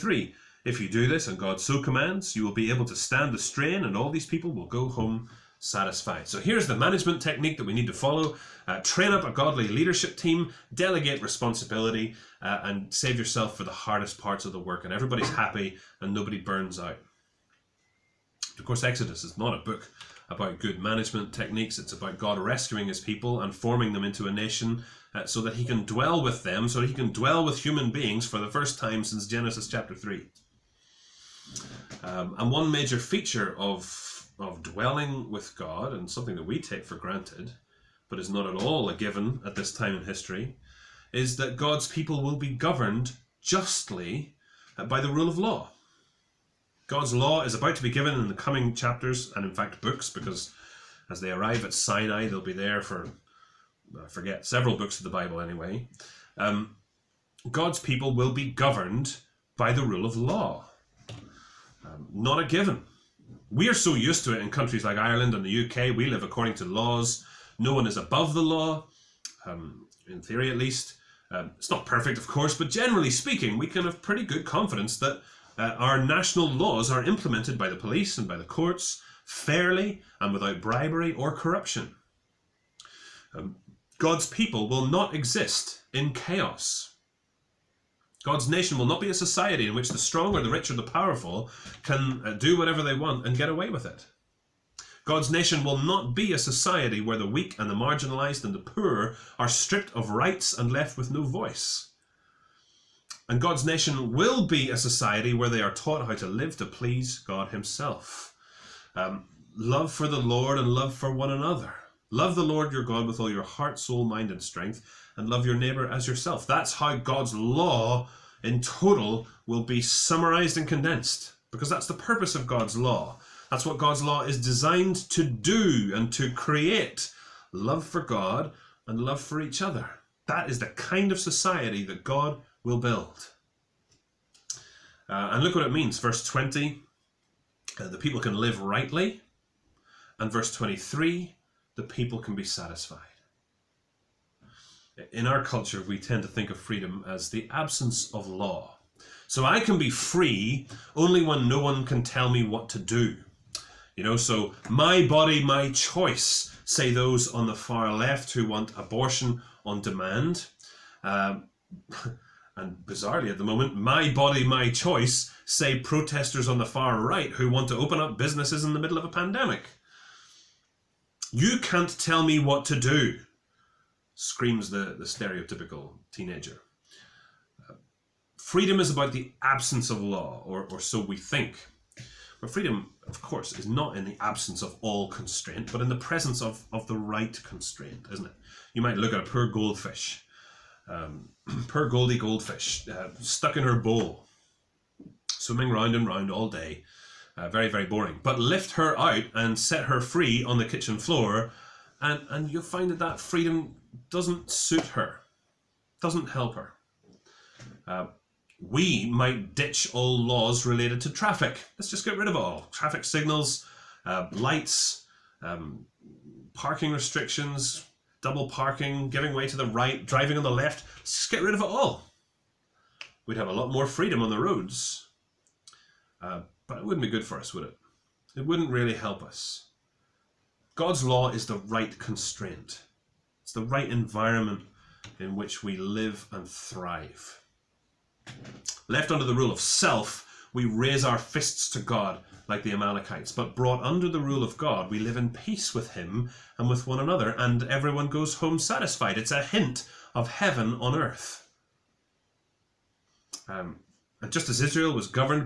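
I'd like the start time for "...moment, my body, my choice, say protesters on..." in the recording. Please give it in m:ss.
2:43.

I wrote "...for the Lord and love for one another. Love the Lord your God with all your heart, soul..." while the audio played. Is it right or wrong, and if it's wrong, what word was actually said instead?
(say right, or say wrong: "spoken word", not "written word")
right.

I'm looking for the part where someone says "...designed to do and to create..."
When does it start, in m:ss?
2:04.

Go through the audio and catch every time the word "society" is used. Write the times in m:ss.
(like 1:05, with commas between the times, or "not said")
1:29, 1:36, 1:44, 2:11.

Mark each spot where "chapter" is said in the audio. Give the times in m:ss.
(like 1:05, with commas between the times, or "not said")
0:29, 0:48.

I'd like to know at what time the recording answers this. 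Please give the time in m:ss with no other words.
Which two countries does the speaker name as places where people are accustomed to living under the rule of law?
1:04.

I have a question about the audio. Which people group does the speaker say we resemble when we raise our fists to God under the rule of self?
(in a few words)
The Amalekites.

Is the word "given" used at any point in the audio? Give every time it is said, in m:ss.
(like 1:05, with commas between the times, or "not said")
0:38, 0:47, 1:02.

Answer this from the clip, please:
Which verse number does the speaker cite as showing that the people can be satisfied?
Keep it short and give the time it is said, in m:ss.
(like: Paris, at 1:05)
23, at 2:20.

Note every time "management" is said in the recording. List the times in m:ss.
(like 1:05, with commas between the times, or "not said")
0:06, 0:20.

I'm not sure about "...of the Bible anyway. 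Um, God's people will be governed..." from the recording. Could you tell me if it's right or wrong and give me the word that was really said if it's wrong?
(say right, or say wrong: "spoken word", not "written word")
right.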